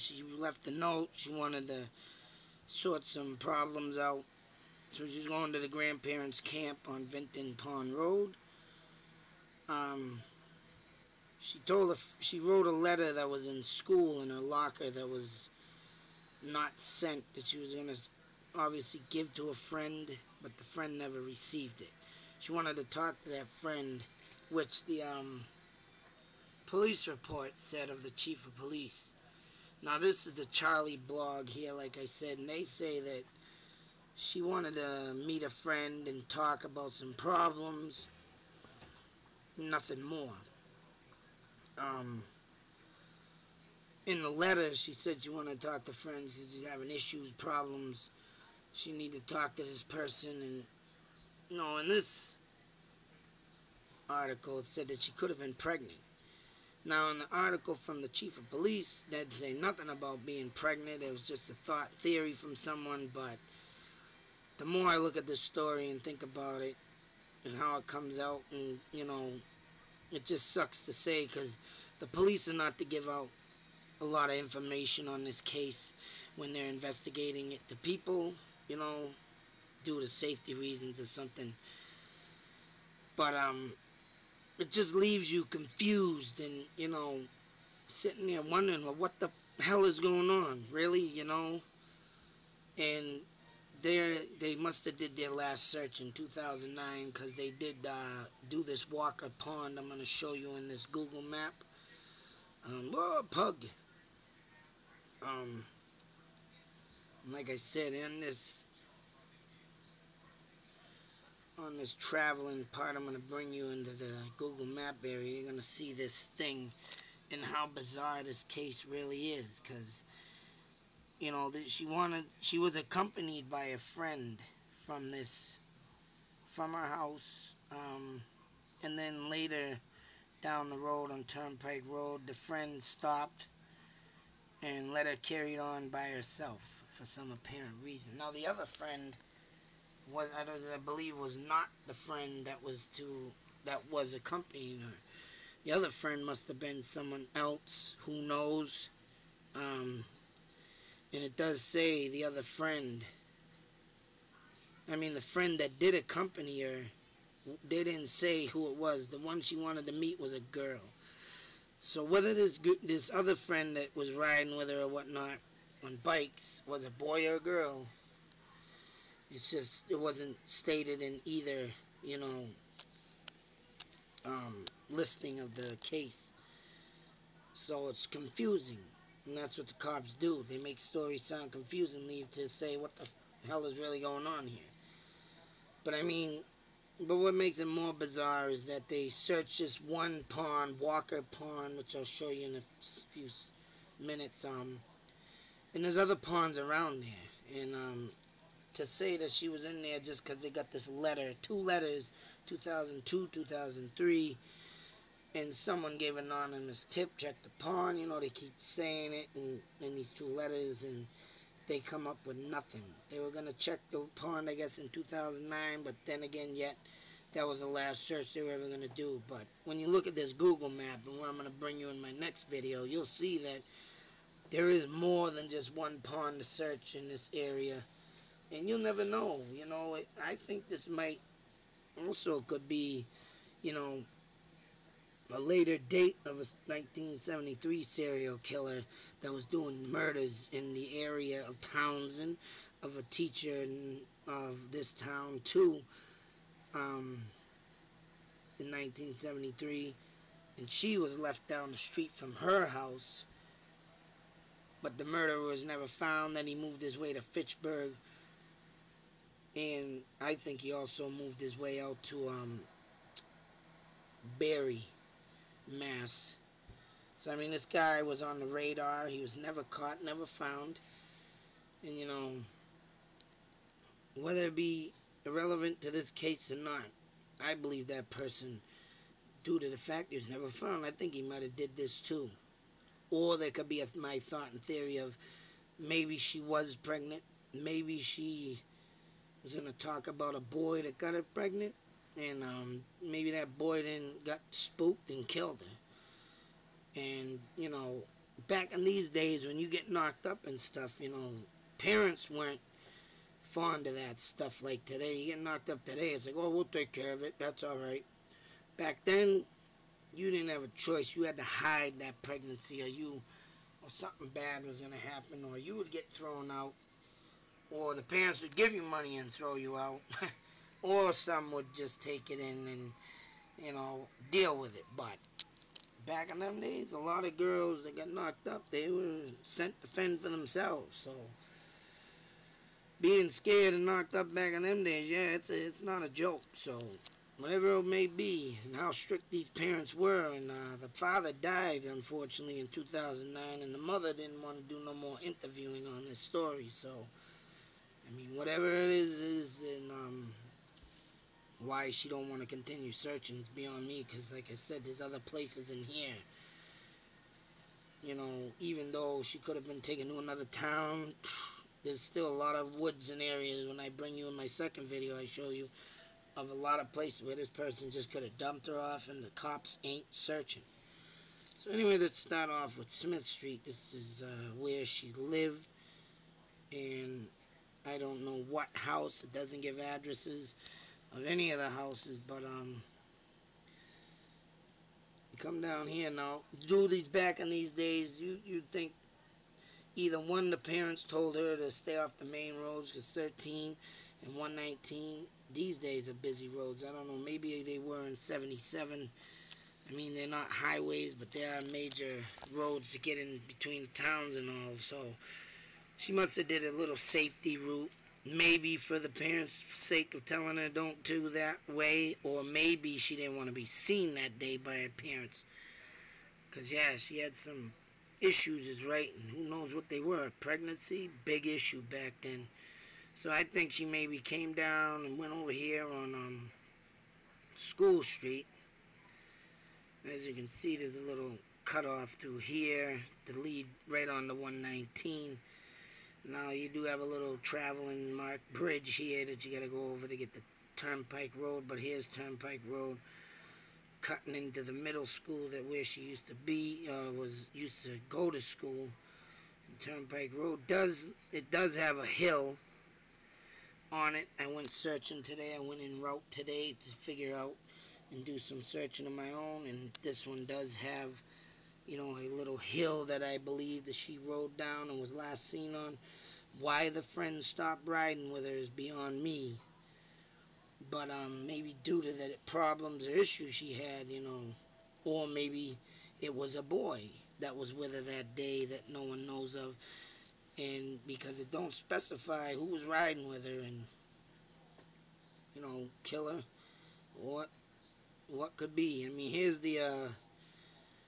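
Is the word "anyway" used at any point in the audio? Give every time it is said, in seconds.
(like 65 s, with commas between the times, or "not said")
371 s.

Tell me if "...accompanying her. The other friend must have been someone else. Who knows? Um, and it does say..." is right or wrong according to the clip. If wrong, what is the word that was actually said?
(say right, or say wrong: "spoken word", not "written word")
right.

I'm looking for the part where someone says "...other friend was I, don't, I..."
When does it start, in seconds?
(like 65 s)
138 s.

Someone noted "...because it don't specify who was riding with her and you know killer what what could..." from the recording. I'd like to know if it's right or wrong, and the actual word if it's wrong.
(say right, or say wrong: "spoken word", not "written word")
right.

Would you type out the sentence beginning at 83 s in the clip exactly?
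But, um, it just leaves you confused and, you know, sitting there wondering, well, what the hell is going on?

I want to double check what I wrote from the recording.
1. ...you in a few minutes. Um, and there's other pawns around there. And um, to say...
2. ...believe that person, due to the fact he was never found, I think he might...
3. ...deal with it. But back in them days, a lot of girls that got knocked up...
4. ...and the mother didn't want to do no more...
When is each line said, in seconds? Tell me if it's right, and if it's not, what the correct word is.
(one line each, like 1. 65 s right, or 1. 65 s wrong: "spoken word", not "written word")
1. 192 s right
2. 277 s right
3. 324 s right
4. 343 s right.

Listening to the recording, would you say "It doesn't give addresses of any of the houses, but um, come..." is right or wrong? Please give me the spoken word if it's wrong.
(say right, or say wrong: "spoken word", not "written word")
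right.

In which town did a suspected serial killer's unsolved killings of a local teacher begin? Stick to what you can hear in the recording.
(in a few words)
Townsend.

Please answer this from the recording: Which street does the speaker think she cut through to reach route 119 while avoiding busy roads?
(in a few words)
School Street.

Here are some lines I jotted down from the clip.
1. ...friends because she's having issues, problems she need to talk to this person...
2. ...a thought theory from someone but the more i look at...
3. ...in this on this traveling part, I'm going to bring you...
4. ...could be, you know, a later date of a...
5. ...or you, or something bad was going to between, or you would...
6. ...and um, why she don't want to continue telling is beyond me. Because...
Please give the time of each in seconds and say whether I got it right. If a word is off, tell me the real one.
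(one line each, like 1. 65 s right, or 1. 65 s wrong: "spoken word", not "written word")
1. 45 s right
2. 61 s right
3. 107 s right
4. 232 s right
5. 312 s wrong: "happen", not "between"
6. 349 s wrong: "searching", not "telling".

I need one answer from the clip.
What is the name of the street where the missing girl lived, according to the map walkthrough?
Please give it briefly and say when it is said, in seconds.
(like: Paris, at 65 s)
Smith Street, at 372 s.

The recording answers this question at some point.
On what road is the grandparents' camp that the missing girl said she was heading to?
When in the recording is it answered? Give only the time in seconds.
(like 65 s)
7 s.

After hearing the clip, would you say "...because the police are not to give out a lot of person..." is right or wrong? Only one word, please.
wrong.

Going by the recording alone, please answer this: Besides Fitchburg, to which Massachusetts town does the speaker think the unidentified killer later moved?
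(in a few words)
Barre.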